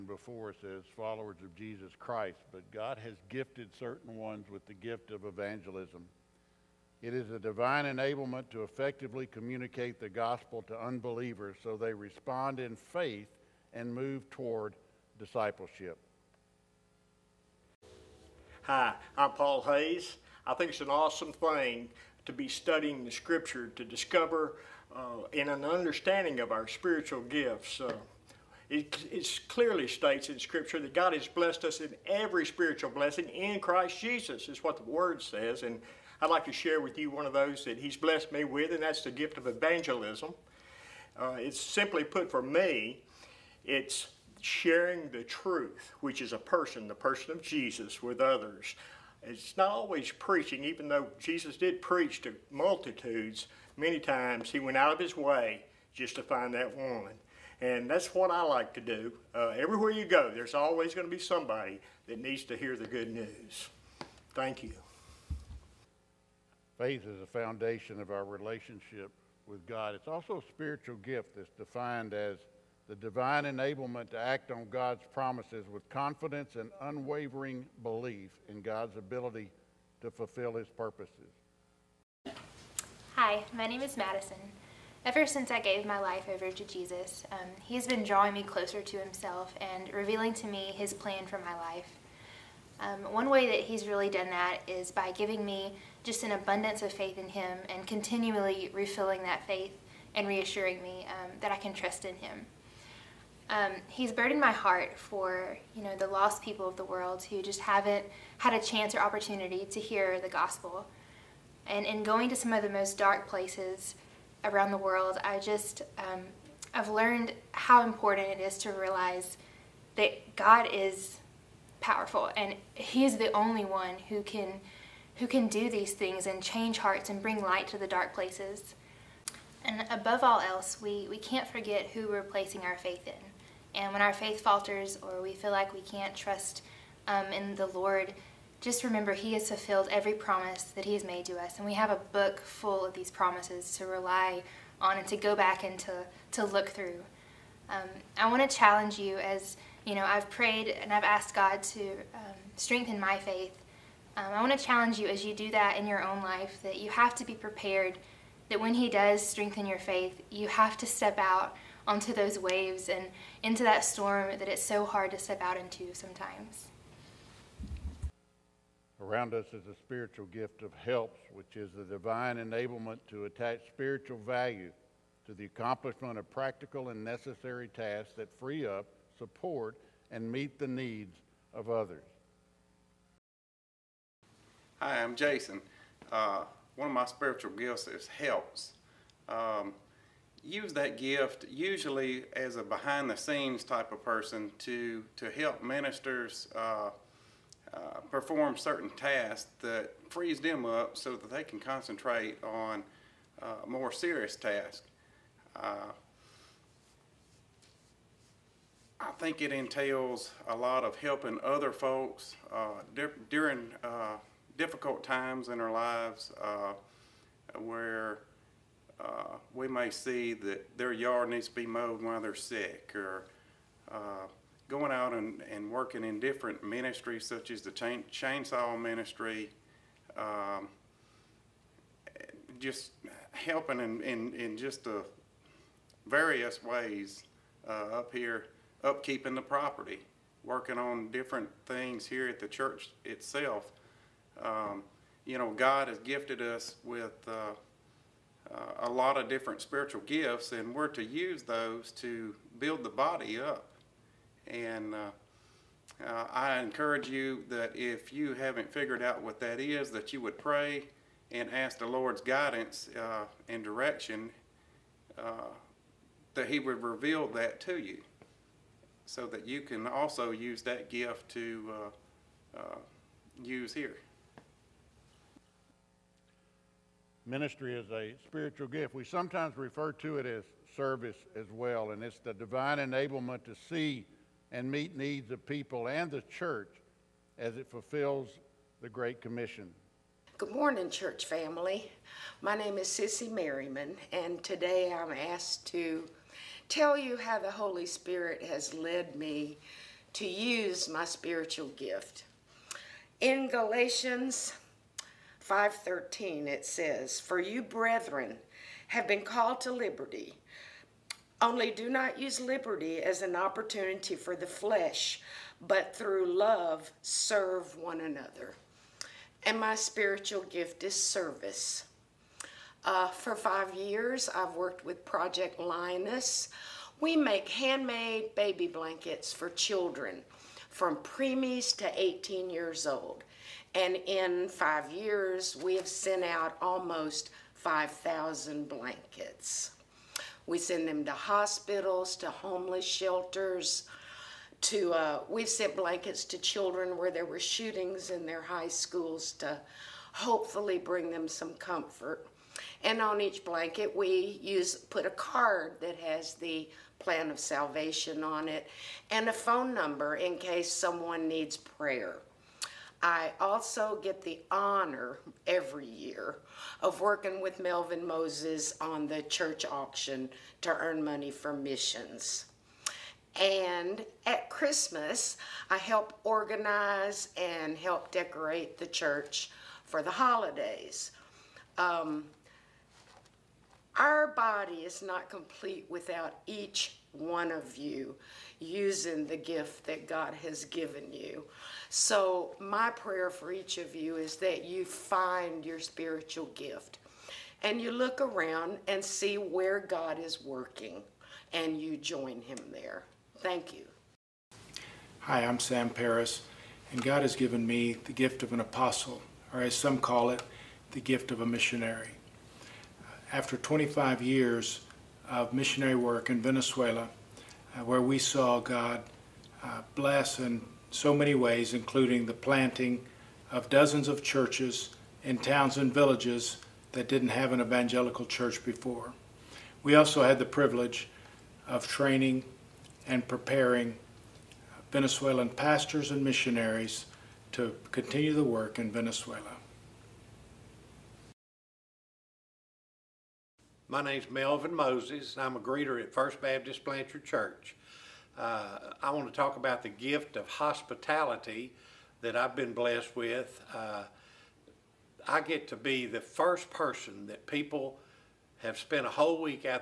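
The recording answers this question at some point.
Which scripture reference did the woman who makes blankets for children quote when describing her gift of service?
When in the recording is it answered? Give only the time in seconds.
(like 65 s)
303 s.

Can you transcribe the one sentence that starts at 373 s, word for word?
And at Christmas, I help organize and help decorate the church for the holidays.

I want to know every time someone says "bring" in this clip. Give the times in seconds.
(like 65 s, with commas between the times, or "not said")
127 s, 350 s.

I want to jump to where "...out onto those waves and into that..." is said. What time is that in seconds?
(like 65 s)
161 s.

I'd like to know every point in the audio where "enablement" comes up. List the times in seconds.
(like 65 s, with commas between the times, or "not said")
7 s, 73 s, 172 s, 282 s.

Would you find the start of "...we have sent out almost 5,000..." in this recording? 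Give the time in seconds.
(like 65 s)
335 s.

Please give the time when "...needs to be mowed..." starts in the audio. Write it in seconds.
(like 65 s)
221 s.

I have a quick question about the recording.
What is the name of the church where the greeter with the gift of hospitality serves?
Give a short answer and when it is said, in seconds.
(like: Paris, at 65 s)
First Baptist Blanchard, at 446 s.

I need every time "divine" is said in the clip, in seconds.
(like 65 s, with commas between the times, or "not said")
7 s, 72 s, 171 s, 282 s.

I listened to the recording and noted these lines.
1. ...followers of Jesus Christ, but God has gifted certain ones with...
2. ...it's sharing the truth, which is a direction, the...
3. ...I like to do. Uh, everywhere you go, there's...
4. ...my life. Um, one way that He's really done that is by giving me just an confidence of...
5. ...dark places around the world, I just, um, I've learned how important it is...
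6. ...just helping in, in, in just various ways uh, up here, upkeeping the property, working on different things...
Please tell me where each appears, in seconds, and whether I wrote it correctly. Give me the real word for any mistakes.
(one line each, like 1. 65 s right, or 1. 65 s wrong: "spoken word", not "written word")
1. 0 s right
2. 43 s wrong: "person", not "direction"
3. 58 s right
4. 91 s wrong: "abundance", not "confidence"
5. 112 s right
6. 232 s right.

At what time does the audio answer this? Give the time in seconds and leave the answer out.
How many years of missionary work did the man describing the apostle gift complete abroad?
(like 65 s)
413 s.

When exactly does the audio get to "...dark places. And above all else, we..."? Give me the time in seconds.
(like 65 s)
127 s.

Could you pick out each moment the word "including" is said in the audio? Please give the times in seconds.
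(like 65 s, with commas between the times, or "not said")
421 s.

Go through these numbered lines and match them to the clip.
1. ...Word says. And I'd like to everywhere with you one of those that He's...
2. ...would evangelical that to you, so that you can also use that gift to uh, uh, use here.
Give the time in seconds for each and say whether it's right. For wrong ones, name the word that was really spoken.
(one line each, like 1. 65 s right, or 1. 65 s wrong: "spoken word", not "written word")
1. 34 s wrong: "share", not "everywhere"
2. 266 s wrong: "reveal", not "evangelical".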